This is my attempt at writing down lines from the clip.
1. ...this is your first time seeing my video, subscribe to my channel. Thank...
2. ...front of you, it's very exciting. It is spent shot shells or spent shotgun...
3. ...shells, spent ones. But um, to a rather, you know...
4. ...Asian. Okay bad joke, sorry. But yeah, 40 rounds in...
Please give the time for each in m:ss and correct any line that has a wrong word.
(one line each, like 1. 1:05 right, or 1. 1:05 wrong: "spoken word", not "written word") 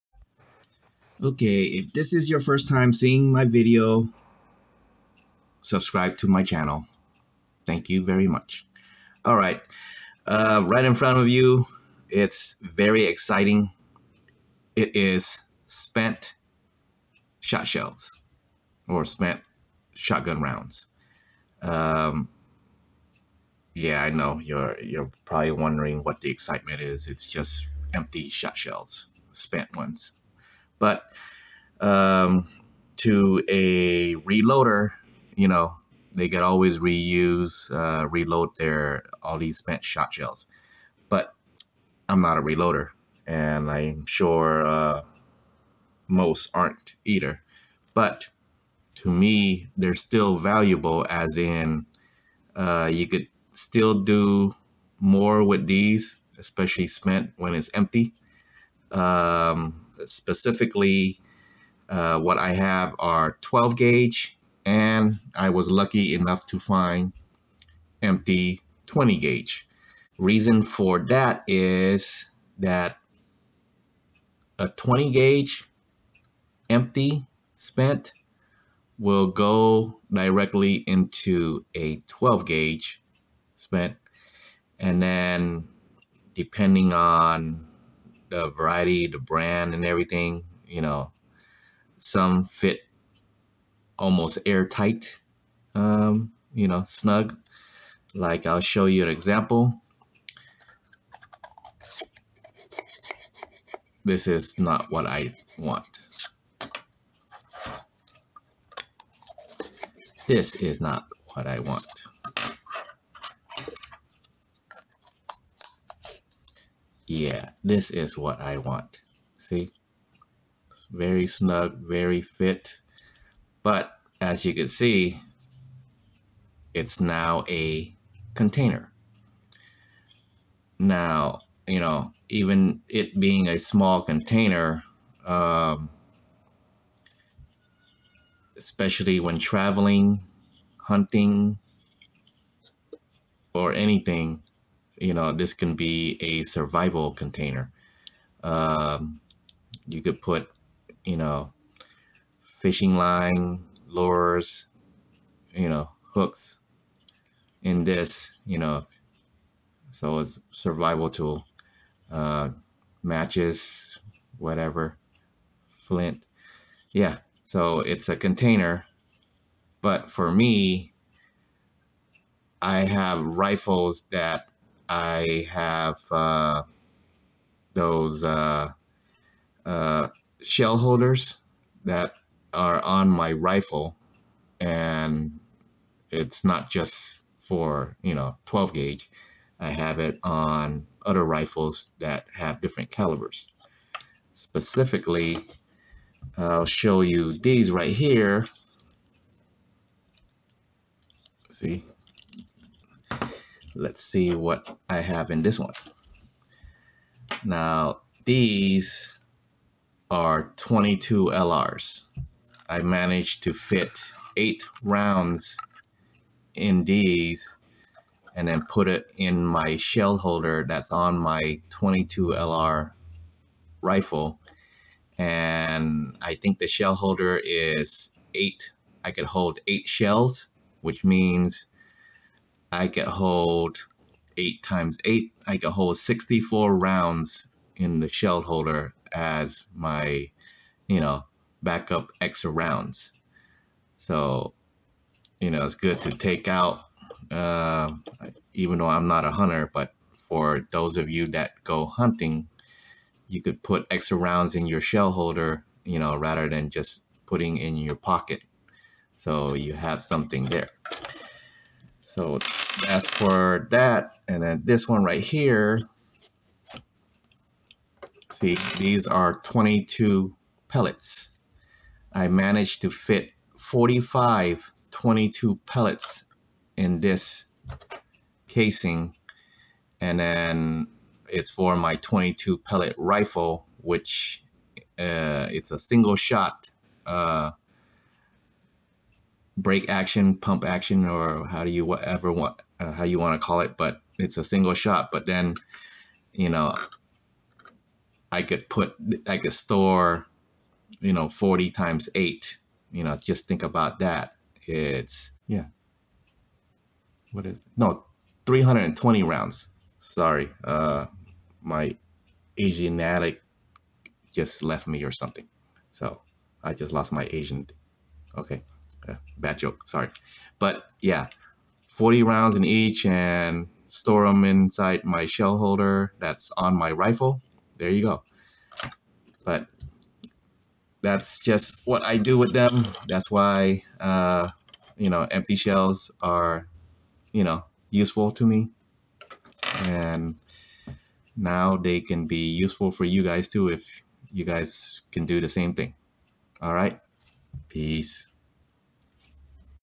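1. 0:01 right
2. 0:10 right
3. 0:28 wrong: "reloader", not "rather"
4. 5:17 right.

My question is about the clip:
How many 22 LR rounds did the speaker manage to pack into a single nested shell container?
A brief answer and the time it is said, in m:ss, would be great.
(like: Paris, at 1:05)
8, at 3:34.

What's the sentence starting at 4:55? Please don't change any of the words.
But then, you know, I could put I could store, you know, forty times eight.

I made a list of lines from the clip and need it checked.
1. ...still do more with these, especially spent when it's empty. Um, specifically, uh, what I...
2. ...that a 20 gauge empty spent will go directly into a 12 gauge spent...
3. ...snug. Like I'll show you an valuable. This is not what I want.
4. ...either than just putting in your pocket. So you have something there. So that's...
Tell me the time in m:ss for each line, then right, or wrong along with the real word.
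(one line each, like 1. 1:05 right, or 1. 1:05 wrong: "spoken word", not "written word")
1. 0:53 right
2. 1:12 right
3. 1:36 wrong: "example", not "valuable"
4. 4:16 wrong: "rather", not "either".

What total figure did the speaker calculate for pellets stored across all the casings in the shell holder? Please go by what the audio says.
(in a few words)
320.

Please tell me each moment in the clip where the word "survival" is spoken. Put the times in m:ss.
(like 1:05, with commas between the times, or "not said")
2:26, 2:40.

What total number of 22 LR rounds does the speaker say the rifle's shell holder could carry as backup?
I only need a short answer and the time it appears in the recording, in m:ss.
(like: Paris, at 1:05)
64, at 3:55.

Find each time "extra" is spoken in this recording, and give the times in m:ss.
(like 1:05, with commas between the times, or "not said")
4:02, 4:13.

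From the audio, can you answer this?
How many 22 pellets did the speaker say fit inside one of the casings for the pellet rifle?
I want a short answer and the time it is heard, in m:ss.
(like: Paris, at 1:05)
45, at 4:33.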